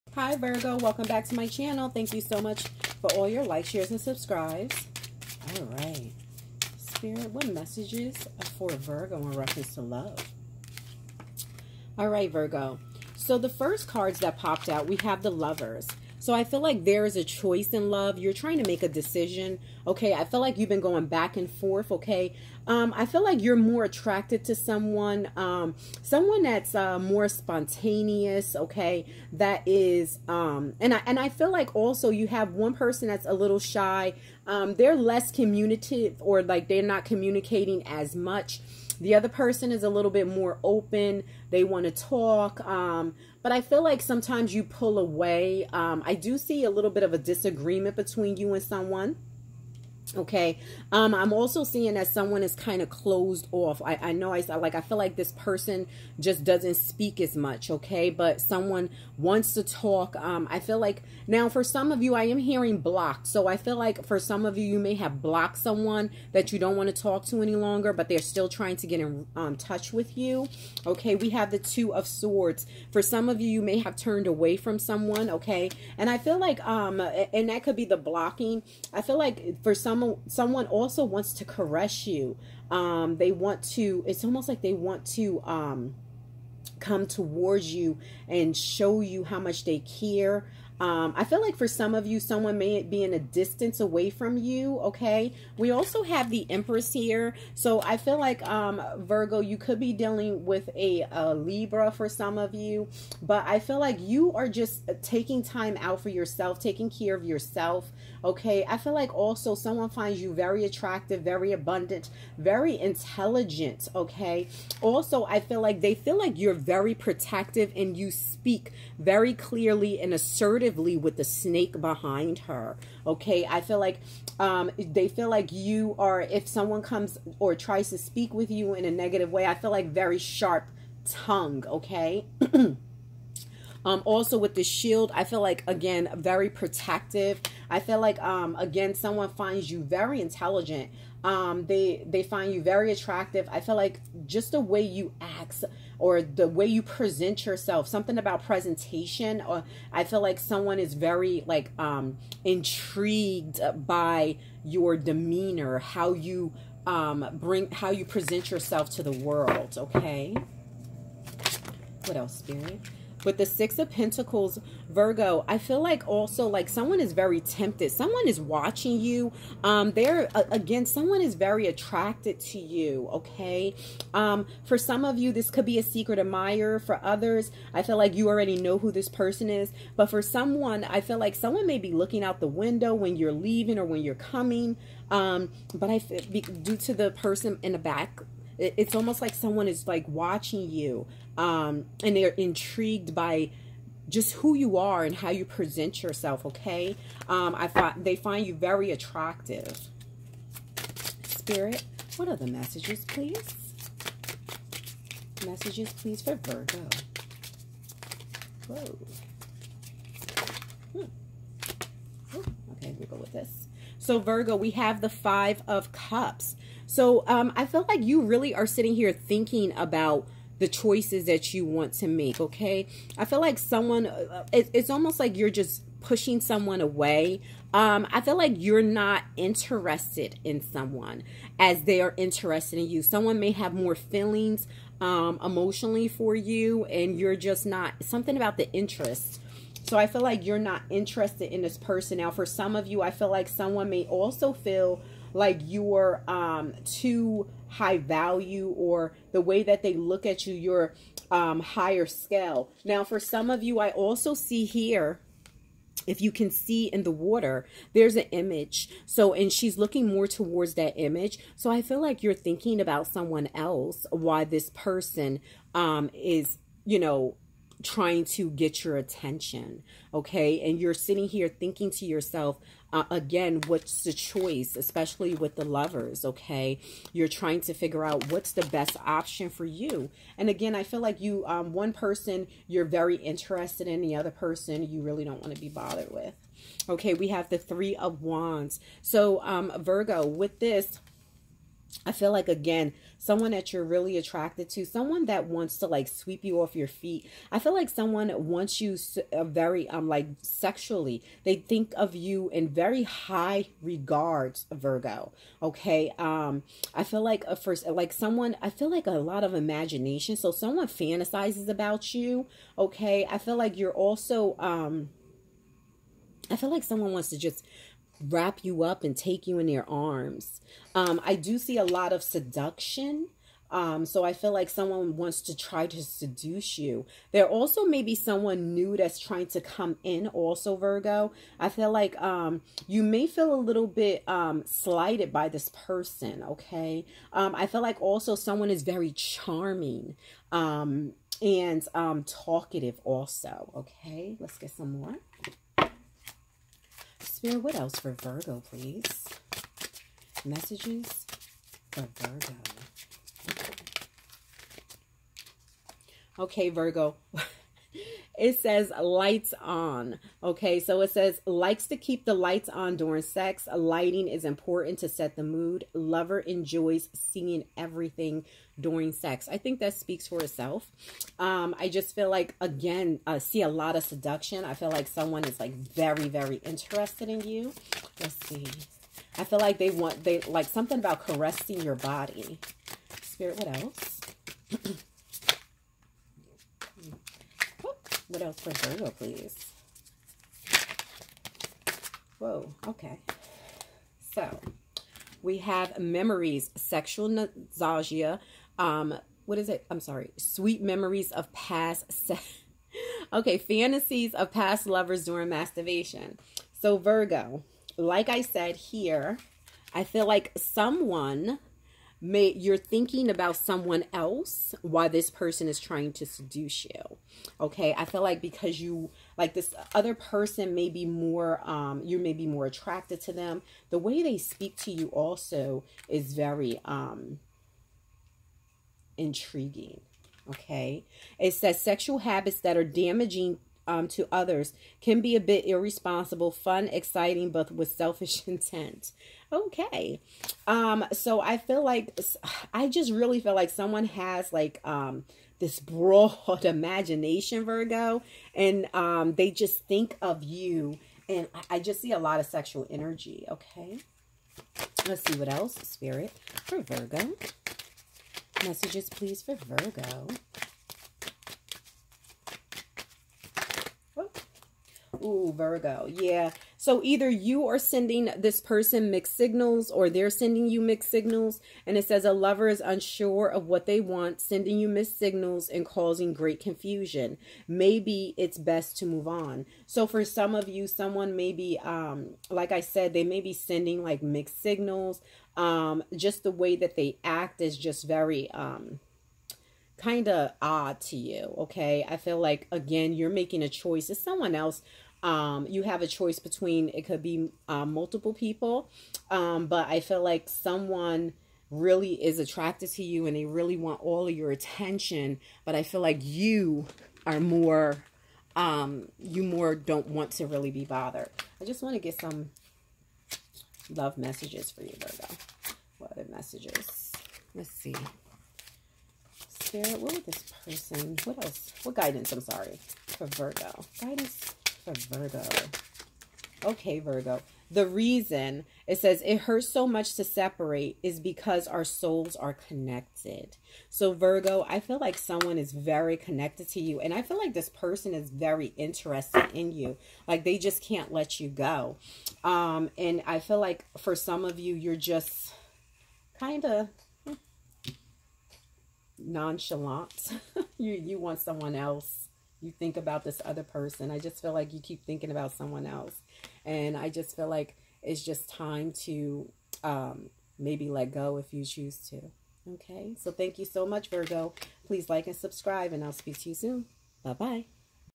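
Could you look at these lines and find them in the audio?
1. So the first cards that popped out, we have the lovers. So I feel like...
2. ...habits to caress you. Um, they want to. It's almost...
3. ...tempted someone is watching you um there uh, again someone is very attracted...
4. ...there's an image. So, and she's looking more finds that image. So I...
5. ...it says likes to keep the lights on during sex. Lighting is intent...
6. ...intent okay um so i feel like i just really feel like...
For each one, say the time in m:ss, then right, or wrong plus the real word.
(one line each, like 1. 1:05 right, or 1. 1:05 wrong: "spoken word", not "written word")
1. 0:13 right
2. 1:21 wrong: "wants", not "habits"
3. 2:47 right
4. 4:17 wrong: "towards", not "finds"
5. 6:01 wrong: "important", not "intent"
6. 7:18 right.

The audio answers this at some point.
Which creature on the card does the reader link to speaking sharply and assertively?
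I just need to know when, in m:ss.
2:01.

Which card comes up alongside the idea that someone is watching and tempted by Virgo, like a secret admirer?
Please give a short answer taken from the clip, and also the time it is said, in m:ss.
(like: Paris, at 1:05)
Six of Pentacles, at 2:43.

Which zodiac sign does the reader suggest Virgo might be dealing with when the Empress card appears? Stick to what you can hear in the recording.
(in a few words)
Libra.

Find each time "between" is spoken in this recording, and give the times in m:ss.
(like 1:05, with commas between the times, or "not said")
0:47, 8:16.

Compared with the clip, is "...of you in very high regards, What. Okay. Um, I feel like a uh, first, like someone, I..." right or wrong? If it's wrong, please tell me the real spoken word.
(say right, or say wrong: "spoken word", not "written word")
wrong: "Virgo", not "What".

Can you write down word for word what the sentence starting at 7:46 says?
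Yeah, so either you are sending this person mixed signals or they're sending you mixed signals.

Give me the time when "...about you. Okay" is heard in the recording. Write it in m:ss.
5:11.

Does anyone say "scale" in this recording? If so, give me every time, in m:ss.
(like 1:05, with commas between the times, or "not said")
4:12.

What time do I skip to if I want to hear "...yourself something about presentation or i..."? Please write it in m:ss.
2:27.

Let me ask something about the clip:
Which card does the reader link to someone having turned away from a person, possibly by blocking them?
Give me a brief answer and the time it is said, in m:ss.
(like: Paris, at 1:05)
Two of Swords, at 1:11.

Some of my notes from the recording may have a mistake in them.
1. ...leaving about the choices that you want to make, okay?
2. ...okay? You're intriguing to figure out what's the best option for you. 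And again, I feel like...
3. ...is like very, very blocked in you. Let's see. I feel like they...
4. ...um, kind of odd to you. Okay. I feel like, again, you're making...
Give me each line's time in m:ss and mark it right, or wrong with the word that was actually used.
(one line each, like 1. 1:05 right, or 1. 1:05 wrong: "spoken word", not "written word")
1. 3:39 wrong: "thinking", not "leaving"
2. 4:36 wrong: "trying", not "intriguing"
3. 6:15 wrong: "interested", not "blocked"
4. 8:08 right.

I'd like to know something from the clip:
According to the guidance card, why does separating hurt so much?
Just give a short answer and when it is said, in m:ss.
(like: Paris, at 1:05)
our souls are connected, at 8:51.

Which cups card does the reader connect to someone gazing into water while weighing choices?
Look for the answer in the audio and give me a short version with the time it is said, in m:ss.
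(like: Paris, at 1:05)
Five of Cups, at 3:35.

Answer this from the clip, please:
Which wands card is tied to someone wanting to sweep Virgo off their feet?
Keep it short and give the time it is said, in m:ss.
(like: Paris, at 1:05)
Three of Wands, at 4:47.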